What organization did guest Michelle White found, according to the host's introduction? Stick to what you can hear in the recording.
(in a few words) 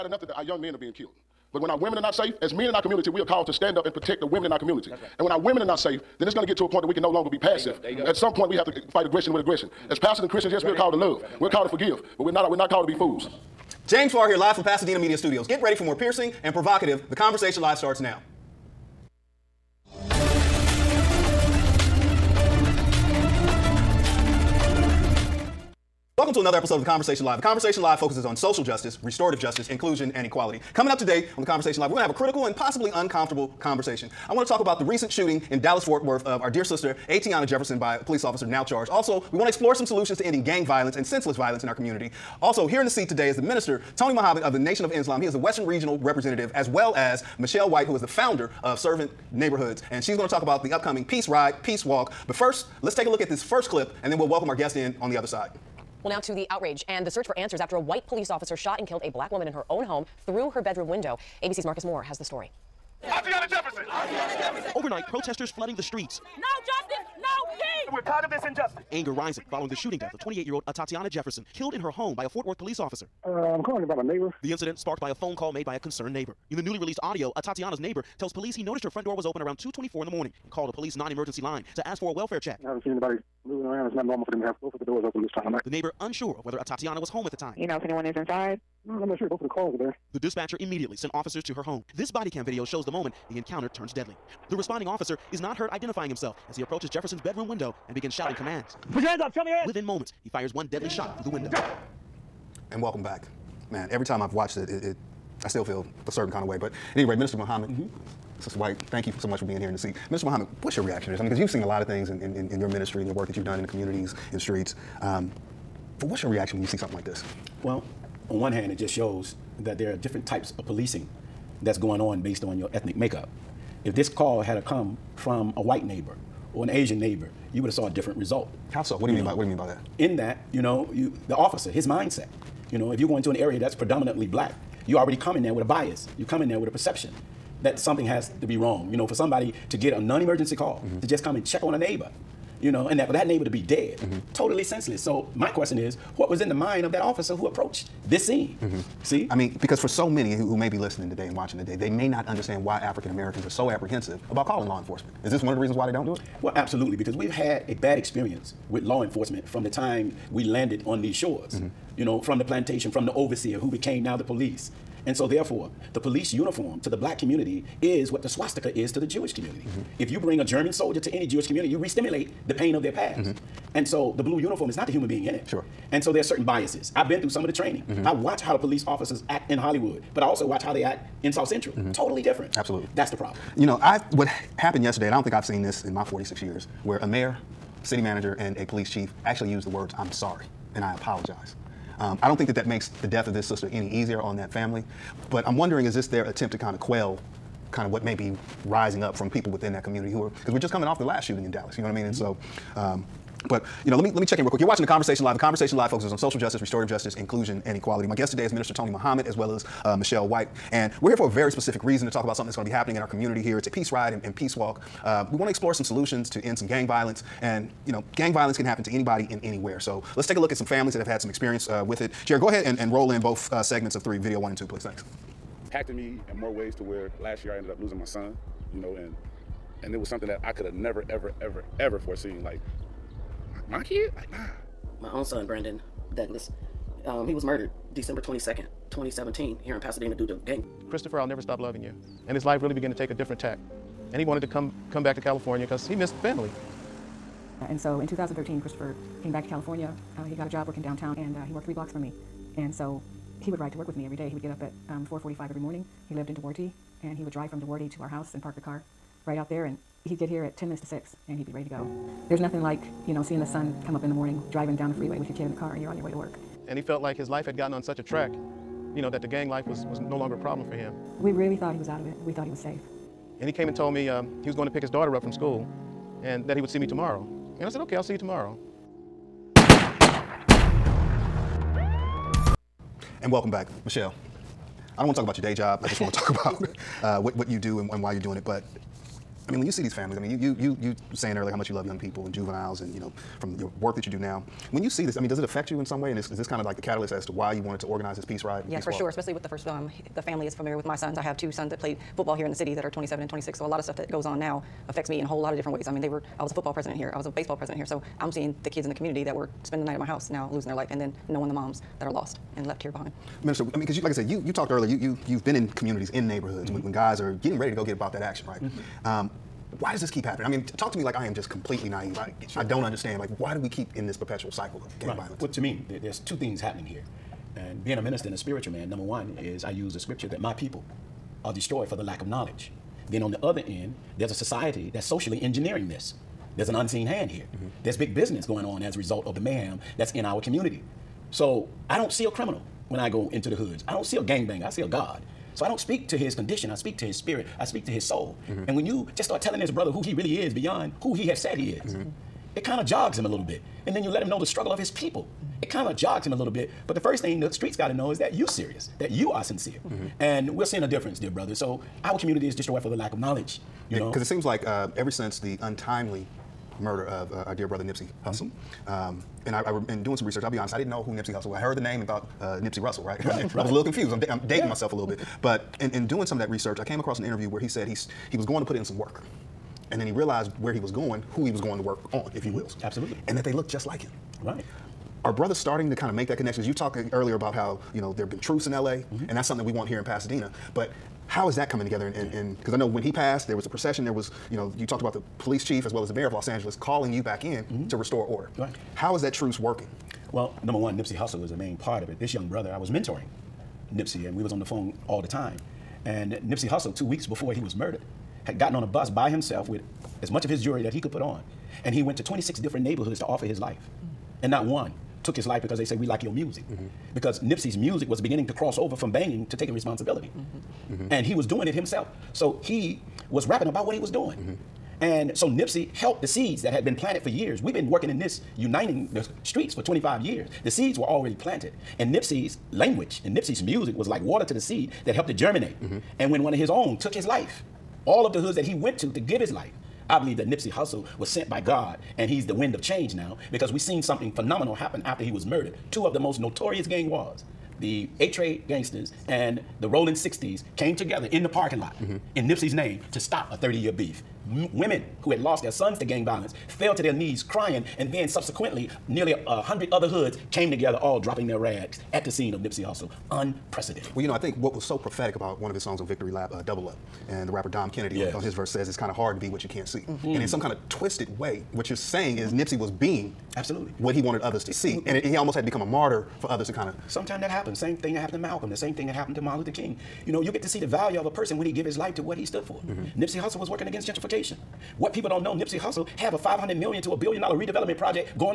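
Servant Neighborhoods.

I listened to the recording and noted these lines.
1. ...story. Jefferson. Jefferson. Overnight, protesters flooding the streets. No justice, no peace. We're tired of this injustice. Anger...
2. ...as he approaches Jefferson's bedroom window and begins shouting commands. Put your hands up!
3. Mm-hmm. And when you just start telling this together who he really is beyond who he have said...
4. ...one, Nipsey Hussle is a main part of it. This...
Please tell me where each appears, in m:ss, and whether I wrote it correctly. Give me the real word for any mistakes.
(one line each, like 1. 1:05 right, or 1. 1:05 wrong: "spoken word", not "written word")
1. 1:02 right
2. 1:36 right
3. 5:48 wrong: "brother", not "together"
4. 6:40 right.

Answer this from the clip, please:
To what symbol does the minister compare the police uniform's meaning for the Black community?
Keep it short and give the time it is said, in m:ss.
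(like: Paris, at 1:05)
The swastika, at 2:48.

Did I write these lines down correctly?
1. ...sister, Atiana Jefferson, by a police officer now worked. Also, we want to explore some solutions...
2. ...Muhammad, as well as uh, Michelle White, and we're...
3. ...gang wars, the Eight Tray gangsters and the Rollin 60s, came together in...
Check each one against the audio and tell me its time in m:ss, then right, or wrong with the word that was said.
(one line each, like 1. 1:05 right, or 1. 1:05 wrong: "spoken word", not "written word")
1. 0:36 wrong: "charged", not "worked"
2. 3:28 right
3. 7:26 right.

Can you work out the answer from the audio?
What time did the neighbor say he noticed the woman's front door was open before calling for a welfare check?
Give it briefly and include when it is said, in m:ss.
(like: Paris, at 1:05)
2:24, at 1:19.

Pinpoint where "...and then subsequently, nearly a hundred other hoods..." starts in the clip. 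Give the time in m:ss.
7:37.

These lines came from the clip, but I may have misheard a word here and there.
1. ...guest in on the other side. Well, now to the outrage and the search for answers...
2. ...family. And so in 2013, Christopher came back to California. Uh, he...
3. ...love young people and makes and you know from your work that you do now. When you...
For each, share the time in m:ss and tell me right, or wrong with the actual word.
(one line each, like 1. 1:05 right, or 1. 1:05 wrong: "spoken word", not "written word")
1. 0:54 right
2. 4:06 right
3. 4:51 wrong: "juveniles", not "makes".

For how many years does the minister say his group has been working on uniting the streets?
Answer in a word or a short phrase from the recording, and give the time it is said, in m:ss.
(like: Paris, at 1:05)
25, at 7:09.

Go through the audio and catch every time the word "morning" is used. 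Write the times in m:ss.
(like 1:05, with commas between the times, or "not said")
1:20, 4:15, 4:24.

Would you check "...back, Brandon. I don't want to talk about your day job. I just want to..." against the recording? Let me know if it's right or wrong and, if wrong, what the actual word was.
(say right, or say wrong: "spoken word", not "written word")
wrong: "Michelle", not "Brandon".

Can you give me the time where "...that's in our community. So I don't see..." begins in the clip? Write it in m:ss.
5:39.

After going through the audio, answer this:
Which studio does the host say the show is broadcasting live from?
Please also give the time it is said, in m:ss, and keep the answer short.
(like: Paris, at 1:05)
Pasadena Media Studios, at 0:14.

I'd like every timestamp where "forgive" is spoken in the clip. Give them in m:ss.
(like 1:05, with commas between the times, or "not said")
0:11.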